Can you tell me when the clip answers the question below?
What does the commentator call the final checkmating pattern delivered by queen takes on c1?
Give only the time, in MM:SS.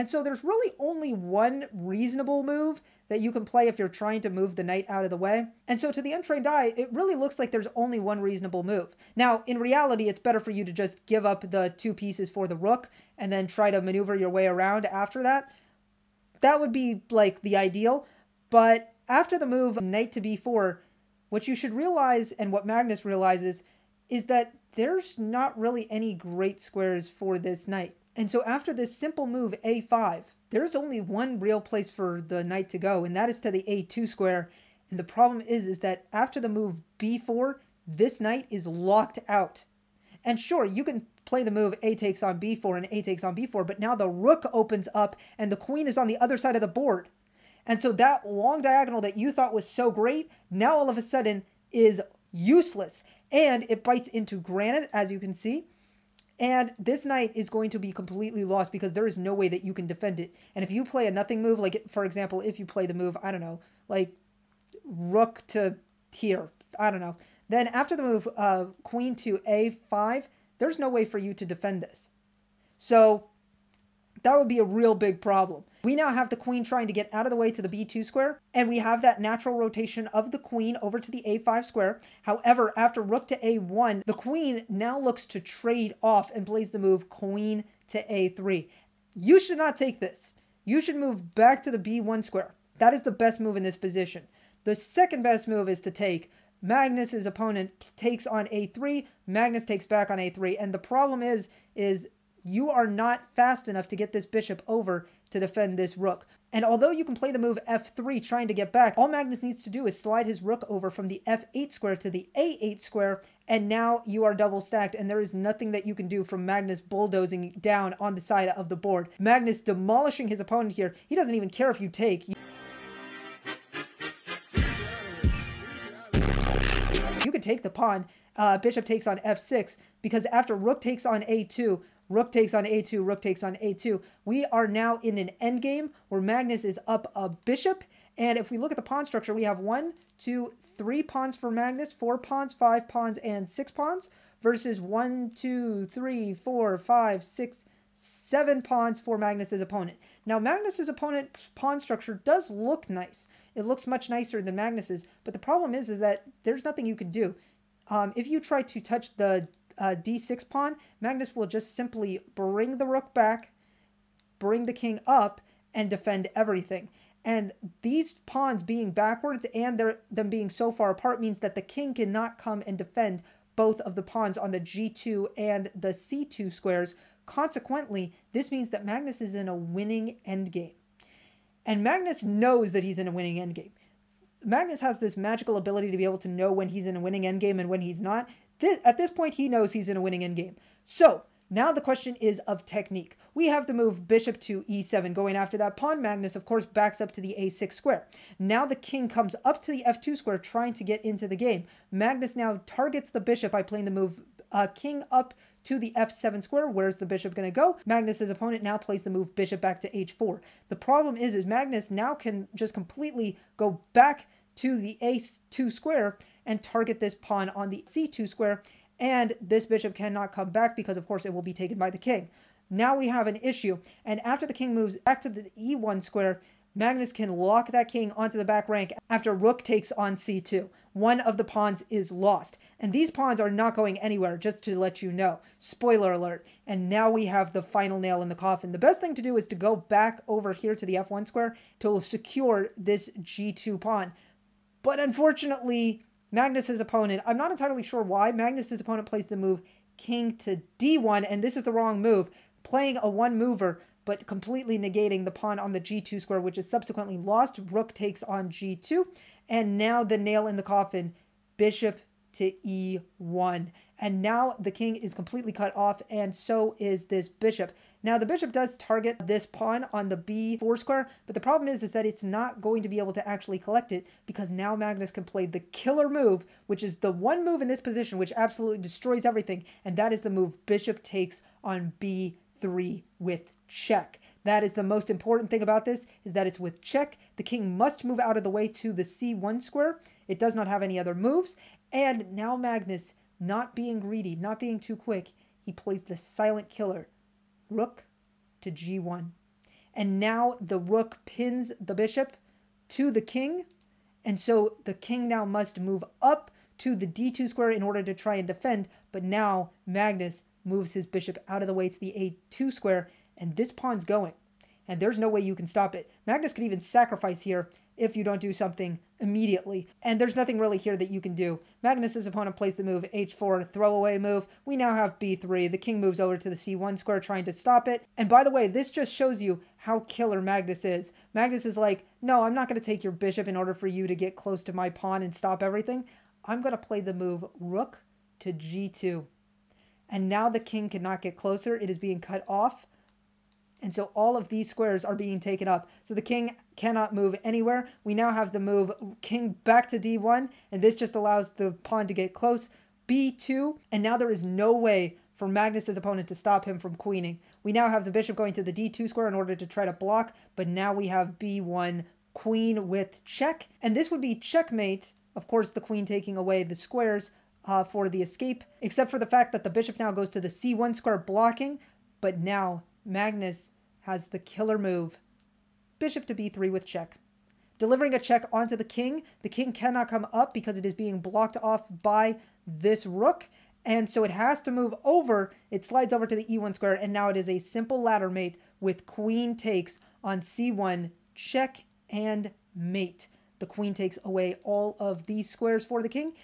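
06:28.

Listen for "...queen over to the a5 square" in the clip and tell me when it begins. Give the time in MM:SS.
01:20.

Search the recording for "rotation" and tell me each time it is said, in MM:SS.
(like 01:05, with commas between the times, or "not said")
01:19.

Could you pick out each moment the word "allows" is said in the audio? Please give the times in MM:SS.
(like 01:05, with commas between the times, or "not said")
05:51.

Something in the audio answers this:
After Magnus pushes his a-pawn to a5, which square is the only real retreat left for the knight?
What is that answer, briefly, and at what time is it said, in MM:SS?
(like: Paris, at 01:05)
a2, at 00:33.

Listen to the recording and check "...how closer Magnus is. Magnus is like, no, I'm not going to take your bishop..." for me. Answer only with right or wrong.
wrong.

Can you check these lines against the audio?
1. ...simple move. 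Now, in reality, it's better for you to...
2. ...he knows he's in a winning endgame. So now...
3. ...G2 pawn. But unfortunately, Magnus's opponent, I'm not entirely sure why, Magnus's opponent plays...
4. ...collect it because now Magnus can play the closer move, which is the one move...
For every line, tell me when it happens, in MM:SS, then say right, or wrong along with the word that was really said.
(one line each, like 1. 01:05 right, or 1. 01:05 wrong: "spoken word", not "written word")
1. 00:08 wrong: "reasonable", not "simple"
2. 03:09 right
3. 04:03 right
4. 04:33 wrong: "killer", not "closer".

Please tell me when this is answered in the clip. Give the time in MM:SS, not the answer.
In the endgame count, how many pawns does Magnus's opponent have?
02:27.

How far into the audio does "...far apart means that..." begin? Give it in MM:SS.
02:50.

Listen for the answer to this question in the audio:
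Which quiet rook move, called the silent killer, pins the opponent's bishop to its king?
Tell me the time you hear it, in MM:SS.
04:57.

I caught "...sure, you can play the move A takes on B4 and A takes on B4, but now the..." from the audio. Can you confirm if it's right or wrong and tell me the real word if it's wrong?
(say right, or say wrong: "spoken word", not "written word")
right.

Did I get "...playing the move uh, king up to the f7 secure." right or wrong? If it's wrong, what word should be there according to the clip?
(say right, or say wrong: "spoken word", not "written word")
wrong: "square", not "secure".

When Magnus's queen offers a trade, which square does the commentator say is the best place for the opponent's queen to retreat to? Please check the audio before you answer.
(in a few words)
b1.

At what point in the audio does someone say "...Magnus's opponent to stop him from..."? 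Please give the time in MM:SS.
05:55.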